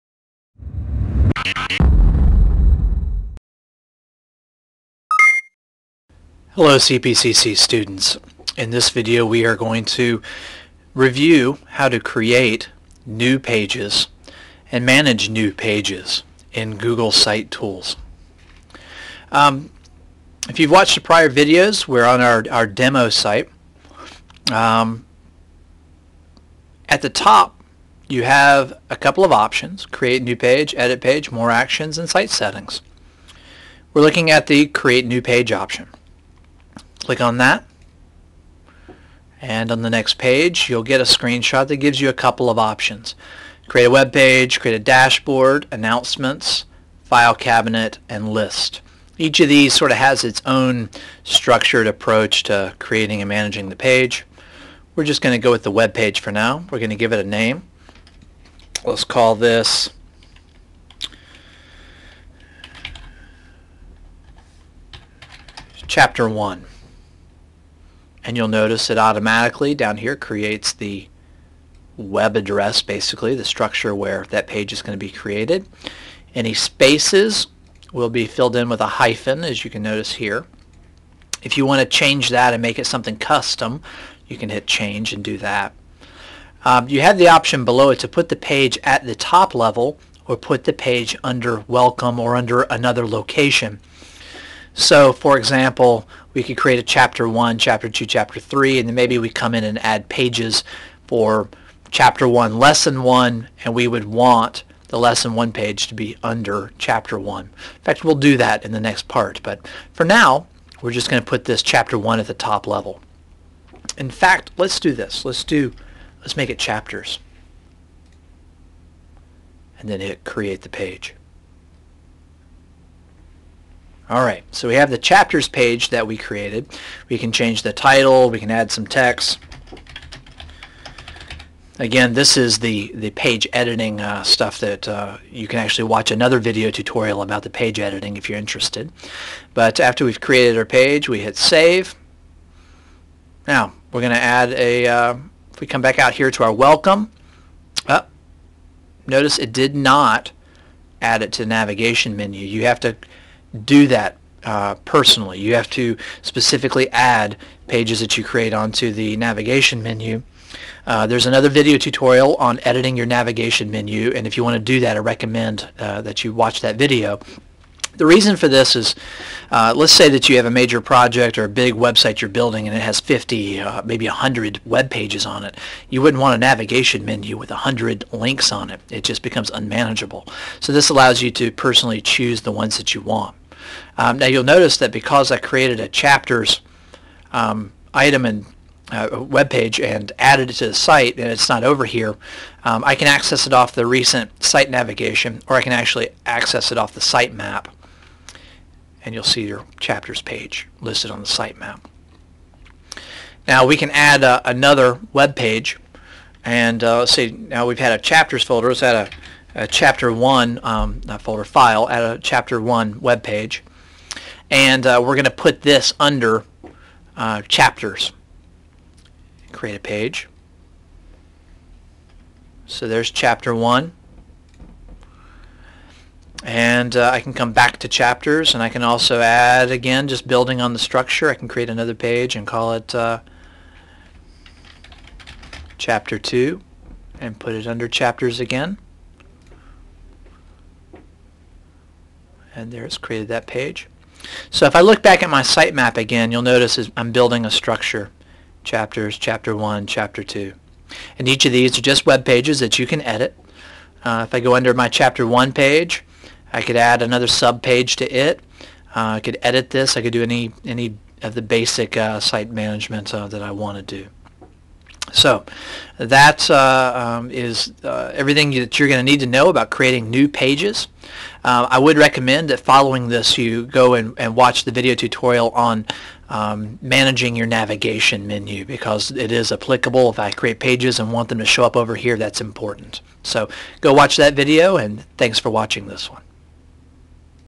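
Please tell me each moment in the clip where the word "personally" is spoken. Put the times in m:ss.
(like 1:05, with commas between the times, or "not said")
2:34, 3:01.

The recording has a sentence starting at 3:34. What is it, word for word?
And uh, we're going to put this under uh, chapters.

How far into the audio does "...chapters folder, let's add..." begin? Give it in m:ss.
3:28.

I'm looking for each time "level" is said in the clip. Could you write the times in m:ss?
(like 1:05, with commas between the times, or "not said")
1:29, 1:52.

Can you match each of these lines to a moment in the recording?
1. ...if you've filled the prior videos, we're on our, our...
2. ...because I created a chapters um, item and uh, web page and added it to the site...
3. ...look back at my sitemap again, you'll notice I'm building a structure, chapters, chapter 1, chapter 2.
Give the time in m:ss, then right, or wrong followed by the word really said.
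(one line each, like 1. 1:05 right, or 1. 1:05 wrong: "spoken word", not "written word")
1. 0:20 wrong: "watched", not "filled"
2. 3:04 right
3. 4:04 right.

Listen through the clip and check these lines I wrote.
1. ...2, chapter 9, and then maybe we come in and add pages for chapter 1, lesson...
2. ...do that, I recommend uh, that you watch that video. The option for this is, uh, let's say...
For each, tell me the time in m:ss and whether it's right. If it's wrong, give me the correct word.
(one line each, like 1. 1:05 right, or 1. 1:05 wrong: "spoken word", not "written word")
1. 1:37 wrong: "3", not "9"
2. 2:44 wrong: "reason", not "option".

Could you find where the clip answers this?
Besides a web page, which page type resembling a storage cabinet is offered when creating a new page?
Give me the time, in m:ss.
0:47.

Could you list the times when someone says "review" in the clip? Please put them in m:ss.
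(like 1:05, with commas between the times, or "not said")
0:10.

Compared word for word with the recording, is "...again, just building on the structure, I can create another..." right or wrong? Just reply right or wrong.
right.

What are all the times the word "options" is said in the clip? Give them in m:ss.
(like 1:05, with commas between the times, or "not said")
0:29, 0:35, 0:42, 1:27.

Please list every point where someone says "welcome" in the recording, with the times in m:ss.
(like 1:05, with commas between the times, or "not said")
1:31, 2:26.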